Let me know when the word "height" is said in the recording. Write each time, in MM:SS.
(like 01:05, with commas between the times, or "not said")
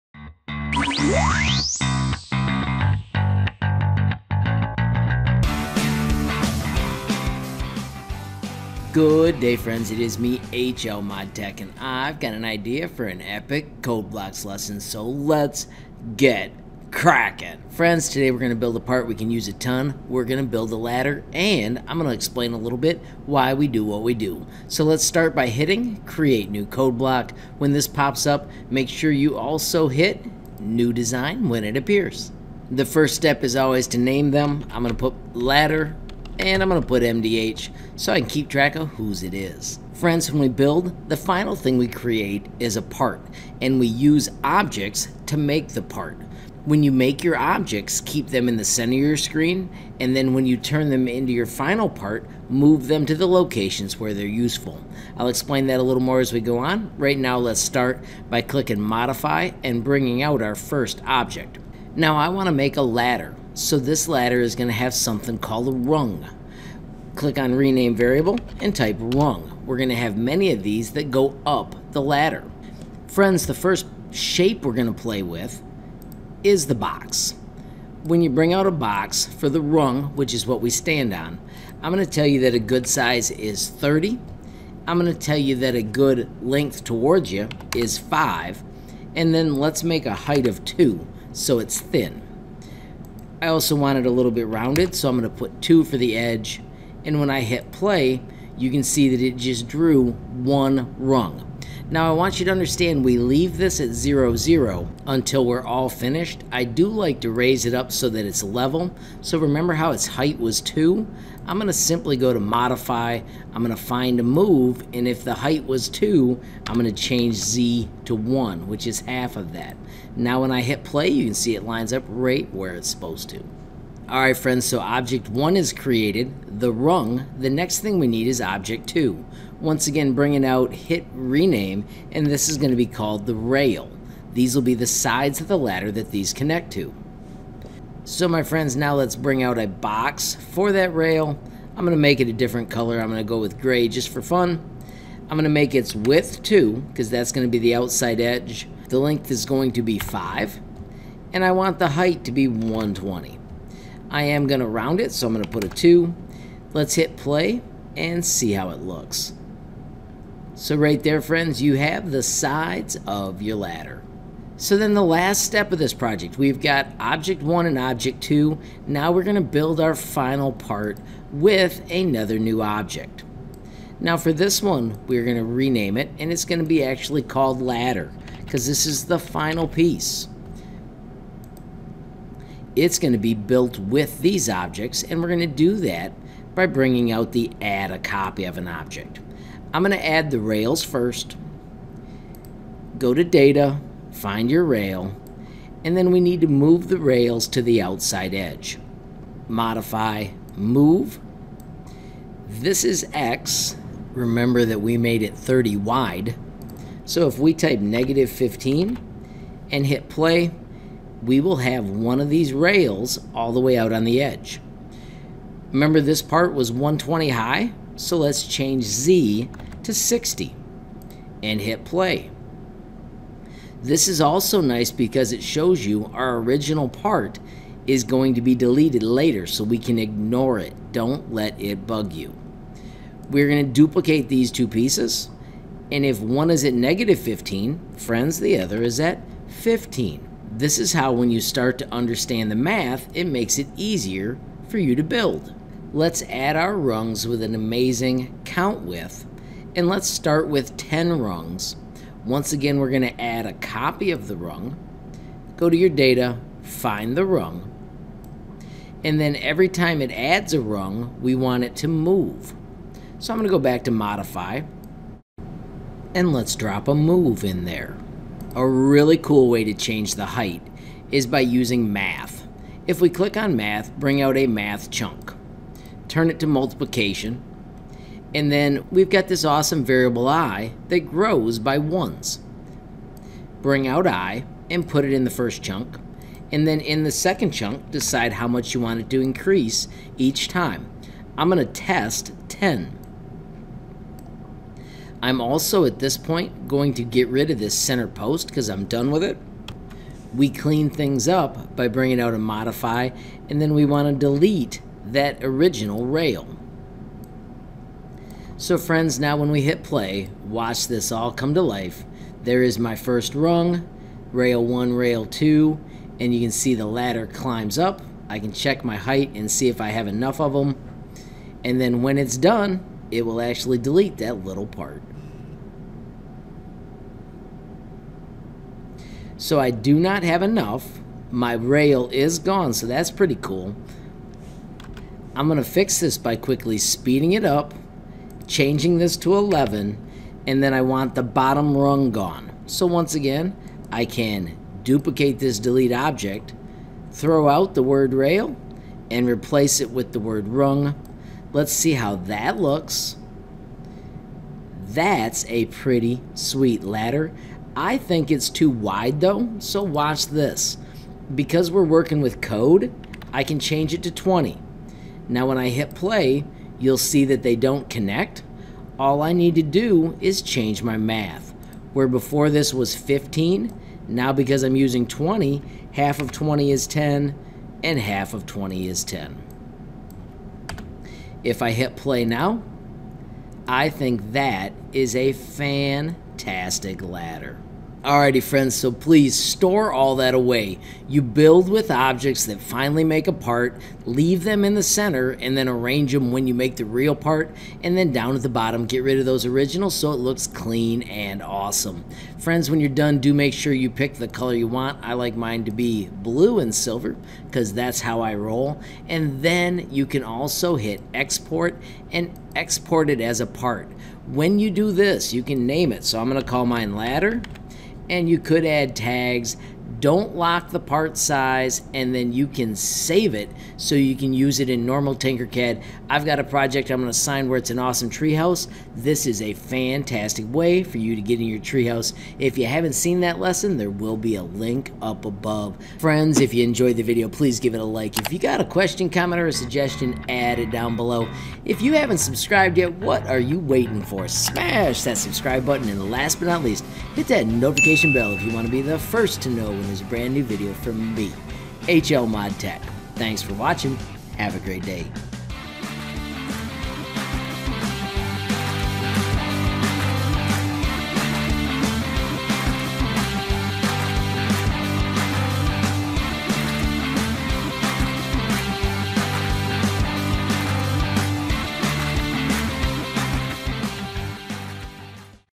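01:30, 01:50, 01:55, 02:31, 04:30, 05:18.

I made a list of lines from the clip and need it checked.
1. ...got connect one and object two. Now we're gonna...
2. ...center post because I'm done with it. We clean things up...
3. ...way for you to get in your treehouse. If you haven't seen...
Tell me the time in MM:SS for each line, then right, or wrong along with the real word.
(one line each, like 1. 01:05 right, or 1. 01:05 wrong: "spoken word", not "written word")
1. 02:46 wrong: "object", not "connect"
2. 04:57 right
3. 07:10 right.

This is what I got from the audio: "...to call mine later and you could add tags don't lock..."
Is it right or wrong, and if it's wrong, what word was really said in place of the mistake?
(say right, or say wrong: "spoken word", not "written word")
wrong: "ladder", not "later".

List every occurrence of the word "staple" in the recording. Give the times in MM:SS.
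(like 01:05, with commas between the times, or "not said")
not said.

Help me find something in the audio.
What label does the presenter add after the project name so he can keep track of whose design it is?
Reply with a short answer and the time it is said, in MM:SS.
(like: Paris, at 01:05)
MDH, at 00:37.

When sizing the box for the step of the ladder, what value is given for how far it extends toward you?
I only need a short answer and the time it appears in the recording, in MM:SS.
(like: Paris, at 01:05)
5, at 01:27.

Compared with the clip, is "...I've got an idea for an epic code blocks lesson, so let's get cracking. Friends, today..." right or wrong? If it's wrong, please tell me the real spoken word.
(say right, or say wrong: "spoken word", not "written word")
right.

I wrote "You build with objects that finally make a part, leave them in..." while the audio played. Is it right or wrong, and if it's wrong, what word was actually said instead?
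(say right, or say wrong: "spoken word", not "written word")
right.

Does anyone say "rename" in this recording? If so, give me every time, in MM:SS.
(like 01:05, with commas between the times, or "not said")
01:07, 02:11, 02:55.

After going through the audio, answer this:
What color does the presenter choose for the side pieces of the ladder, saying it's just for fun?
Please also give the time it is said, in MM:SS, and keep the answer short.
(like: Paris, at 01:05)
Gray, at 02:23.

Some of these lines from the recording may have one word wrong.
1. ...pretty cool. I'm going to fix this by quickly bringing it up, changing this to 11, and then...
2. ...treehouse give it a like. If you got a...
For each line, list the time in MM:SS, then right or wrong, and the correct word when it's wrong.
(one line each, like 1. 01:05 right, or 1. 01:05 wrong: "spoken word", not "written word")
1. 05:33 wrong: "speeding", not "bringing"
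2. 07:17 wrong: "please", not "treehouse".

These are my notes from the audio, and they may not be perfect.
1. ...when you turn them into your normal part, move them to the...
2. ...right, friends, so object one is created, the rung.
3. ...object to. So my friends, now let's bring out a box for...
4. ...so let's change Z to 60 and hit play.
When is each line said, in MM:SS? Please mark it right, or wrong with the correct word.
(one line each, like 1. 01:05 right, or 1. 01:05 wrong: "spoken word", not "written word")
1. 00:50 wrong: "final", not "normal"
2. 02:04 right
3. 02:16 wrong: "connect", not "object"
4. 03:37 right.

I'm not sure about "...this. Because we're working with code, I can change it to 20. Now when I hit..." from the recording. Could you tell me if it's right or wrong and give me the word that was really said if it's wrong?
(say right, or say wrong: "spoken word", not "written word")
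right.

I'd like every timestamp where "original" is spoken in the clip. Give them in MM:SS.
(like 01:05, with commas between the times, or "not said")
03:46, 05:05, 06:39.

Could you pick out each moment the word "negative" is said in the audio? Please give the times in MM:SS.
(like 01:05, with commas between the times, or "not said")
03:27, 03:56.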